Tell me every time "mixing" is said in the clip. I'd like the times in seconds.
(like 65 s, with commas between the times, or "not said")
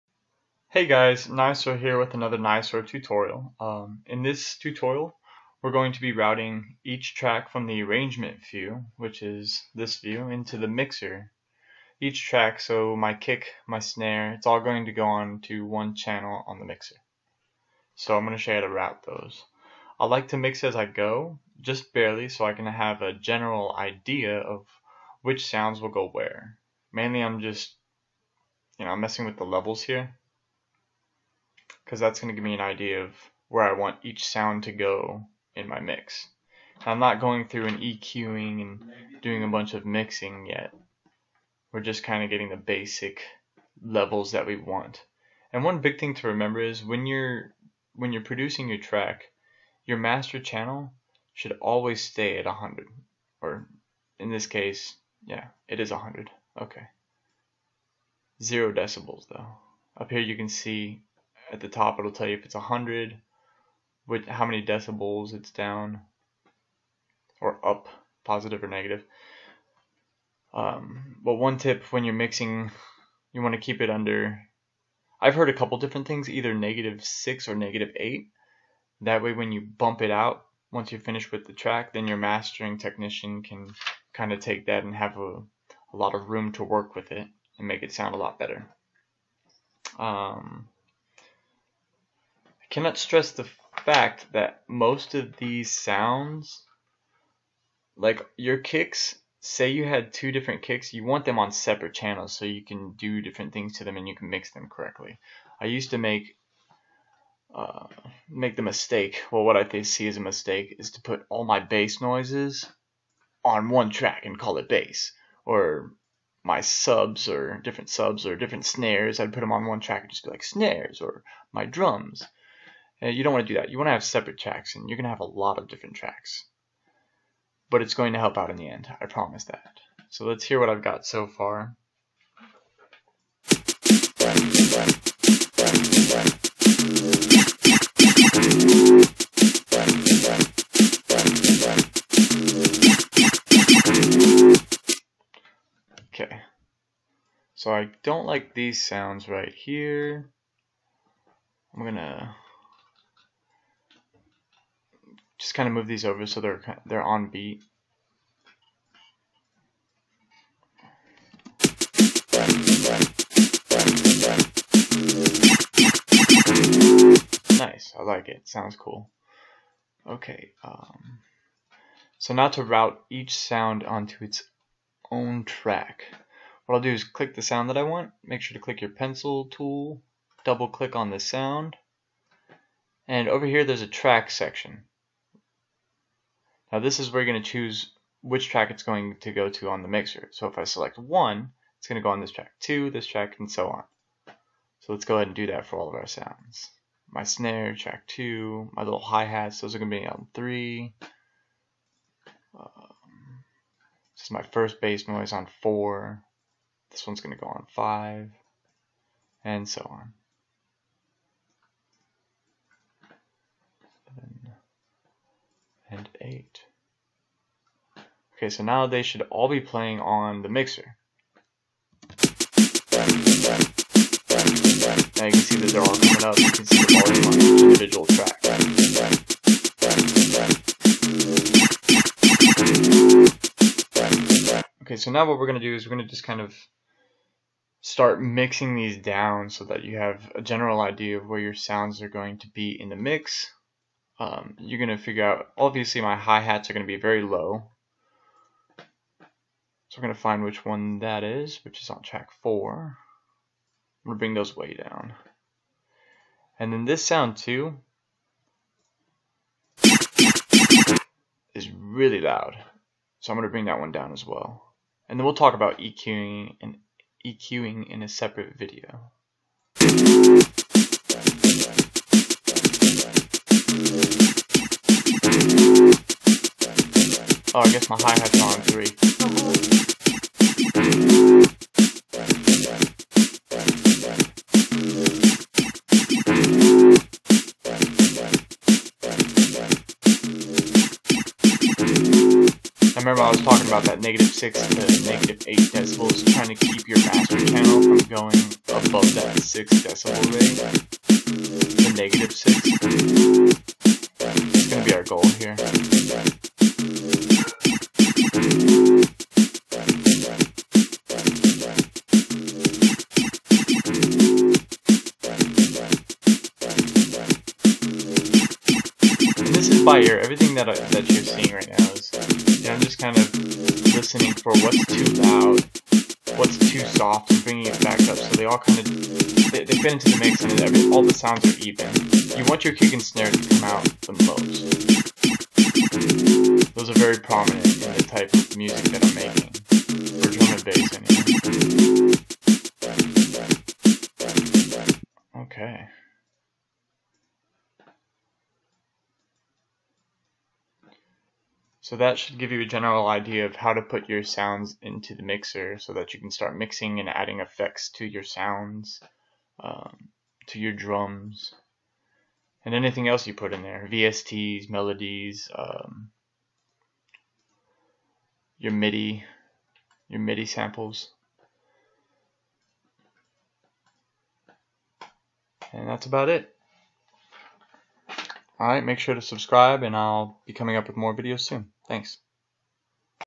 39 s, 72 s, 238 s, 356 s.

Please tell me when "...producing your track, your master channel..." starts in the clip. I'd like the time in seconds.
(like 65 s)
48 s.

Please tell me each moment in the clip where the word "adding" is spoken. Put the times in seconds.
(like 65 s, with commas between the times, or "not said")
357 s.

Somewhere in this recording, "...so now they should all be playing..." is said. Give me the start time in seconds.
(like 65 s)
218 s.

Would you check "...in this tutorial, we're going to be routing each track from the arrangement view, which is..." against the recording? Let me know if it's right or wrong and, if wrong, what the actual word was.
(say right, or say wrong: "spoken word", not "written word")
right.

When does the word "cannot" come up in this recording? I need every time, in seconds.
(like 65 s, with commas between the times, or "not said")
92 s.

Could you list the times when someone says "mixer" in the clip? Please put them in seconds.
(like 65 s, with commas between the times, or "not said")
10 s, 16 s, 189 s, 220 s, 355 s.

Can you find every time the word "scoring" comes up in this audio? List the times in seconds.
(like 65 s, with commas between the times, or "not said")
not said.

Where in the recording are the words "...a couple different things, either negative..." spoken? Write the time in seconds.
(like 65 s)
75 s.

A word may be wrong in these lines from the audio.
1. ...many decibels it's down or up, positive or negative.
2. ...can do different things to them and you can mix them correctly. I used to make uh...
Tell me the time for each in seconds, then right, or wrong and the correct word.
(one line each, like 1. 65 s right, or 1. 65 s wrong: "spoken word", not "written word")
1. 64 s right
2. 102 s right.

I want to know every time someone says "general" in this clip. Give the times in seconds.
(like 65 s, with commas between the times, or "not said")
23 s, 240 s, 352 s.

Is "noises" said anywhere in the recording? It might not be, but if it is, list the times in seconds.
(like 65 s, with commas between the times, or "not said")
111 s, 205 s.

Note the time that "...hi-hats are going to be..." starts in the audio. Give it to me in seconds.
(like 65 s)
246 s.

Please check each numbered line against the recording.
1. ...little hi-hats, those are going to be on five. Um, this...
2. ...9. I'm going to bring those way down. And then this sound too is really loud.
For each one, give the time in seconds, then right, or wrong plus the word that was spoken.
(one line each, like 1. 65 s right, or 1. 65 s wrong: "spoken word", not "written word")
1. 198 s wrong: "three", not "five"
2. 252 s wrong: "4", not "9".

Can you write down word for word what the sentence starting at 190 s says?
So if I select one, it's going to go on this track, two, this track, and so on.